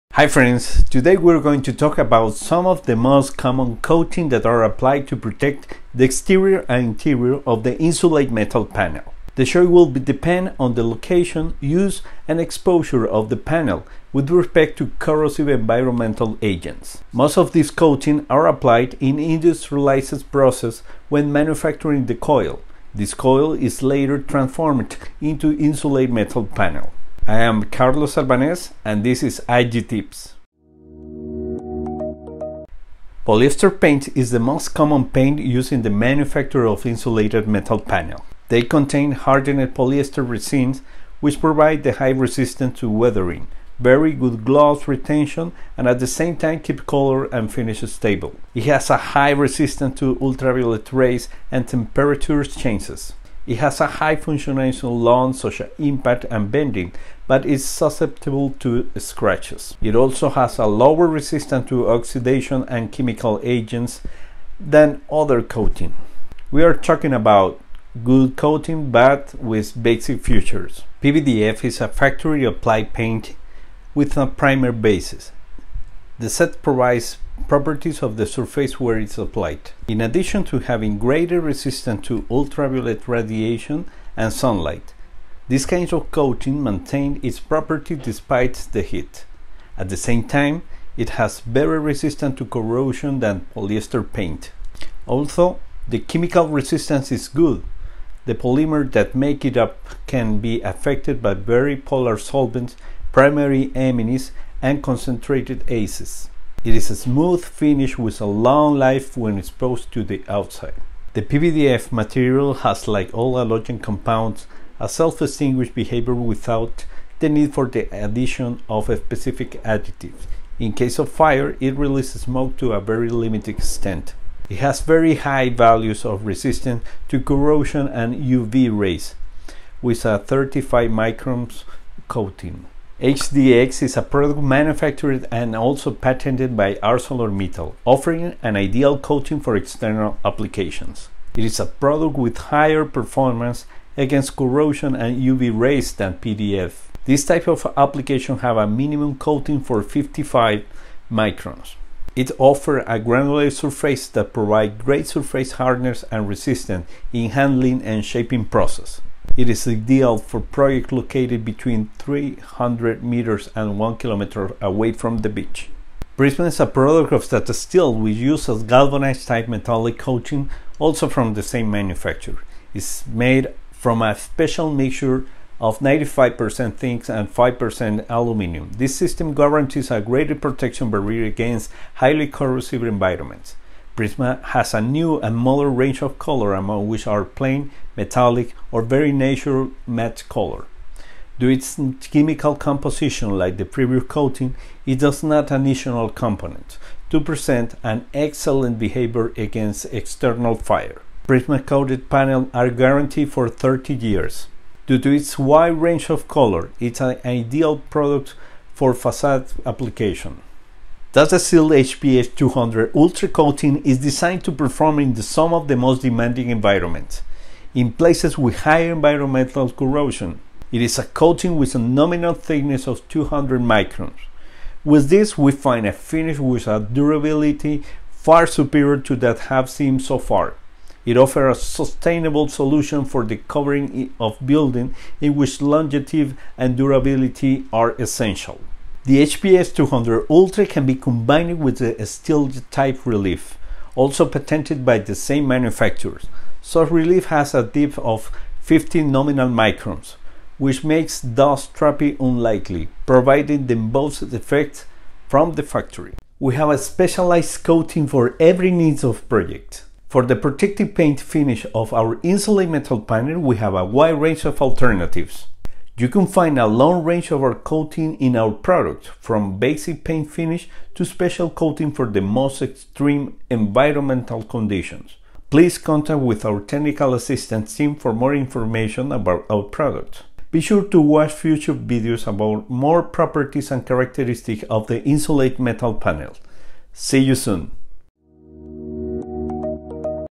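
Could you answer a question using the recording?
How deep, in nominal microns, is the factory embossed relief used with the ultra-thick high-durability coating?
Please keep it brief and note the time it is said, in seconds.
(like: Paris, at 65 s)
15 microns, at 248 s.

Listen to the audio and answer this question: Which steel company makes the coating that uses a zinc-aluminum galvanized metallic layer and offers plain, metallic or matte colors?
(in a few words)
Tata Steel.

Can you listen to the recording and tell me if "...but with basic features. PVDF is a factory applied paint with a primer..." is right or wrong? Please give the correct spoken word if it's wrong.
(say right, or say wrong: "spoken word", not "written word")
right.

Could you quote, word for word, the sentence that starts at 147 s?
This type of application have a minimum coating for 55 microns.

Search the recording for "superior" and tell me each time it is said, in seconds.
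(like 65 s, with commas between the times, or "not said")
228 s.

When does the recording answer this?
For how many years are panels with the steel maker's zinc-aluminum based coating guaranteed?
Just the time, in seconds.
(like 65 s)
203 s.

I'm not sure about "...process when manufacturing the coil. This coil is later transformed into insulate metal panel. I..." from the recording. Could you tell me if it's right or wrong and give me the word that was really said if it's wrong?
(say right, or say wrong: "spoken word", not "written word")
right.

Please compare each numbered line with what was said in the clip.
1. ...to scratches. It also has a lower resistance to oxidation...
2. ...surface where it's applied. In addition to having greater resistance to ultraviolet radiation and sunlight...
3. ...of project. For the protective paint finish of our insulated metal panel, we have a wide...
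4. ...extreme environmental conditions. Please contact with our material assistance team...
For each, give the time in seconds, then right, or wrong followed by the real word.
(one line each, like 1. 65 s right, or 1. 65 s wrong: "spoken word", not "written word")
1. 58 s right
2. 78 s right
3. 259 s right
4. 272 s wrong: "technical", not "material".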